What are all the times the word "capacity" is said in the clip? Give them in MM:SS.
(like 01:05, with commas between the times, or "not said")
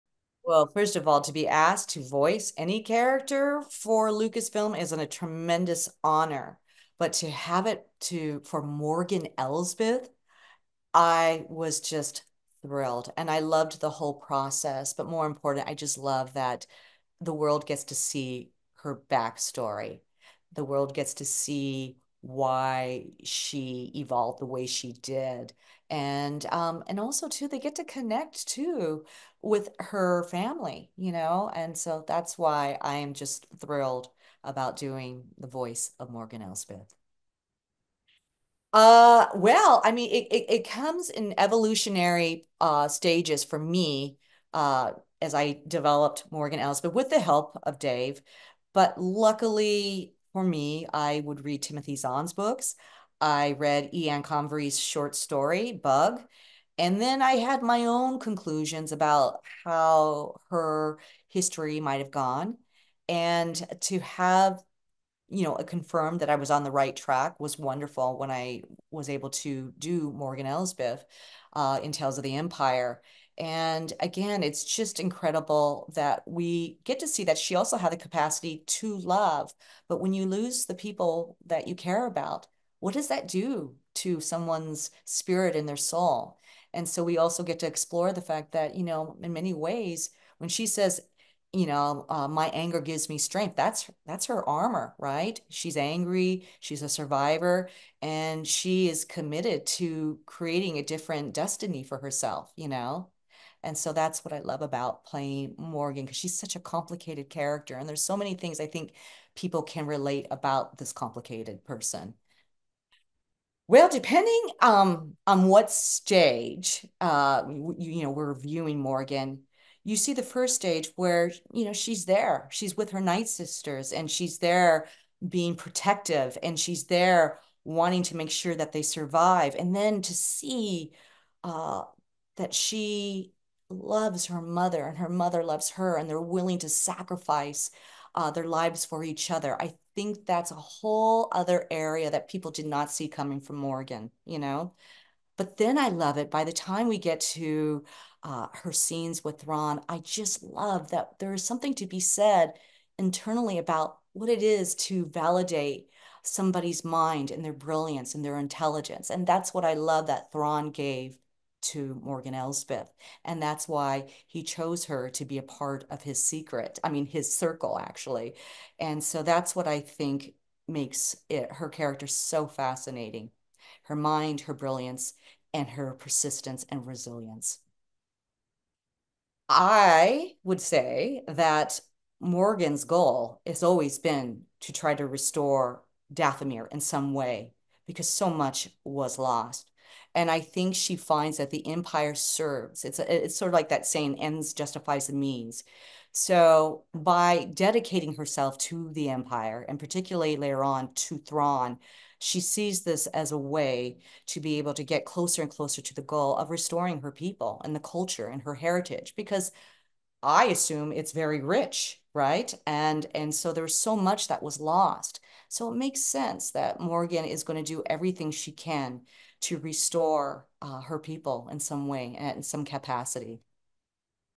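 01:17, 03:42.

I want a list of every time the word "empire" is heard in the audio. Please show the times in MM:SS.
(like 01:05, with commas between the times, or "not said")
01:12, 03:11, 03:19.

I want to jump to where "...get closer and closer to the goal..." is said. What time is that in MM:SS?
03:24.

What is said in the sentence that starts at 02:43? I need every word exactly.
And that's why he chose her to be a part of his secret, I mean, his circle, actually.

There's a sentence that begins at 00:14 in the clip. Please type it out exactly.
But more important, I just love that the world gets to see her backstory.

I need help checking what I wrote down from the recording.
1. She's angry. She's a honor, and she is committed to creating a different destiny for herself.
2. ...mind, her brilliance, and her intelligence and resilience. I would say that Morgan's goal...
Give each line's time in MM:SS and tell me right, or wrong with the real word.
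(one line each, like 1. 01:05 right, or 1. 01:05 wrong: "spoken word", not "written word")
1. 01:35 wrong: "survivor", not "honor"
2. 02:53 wrong: "persistence", not "intelligence".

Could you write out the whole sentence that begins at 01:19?
But when you lose the people that you care about, what does that do to someone's spirit and their soul?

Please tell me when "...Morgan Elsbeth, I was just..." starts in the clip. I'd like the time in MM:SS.
00:08.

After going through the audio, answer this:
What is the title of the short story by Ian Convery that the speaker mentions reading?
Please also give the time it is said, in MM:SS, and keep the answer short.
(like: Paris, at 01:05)
Bug, at 00:55.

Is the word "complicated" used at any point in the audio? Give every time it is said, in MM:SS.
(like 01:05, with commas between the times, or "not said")
01:46, 01:50.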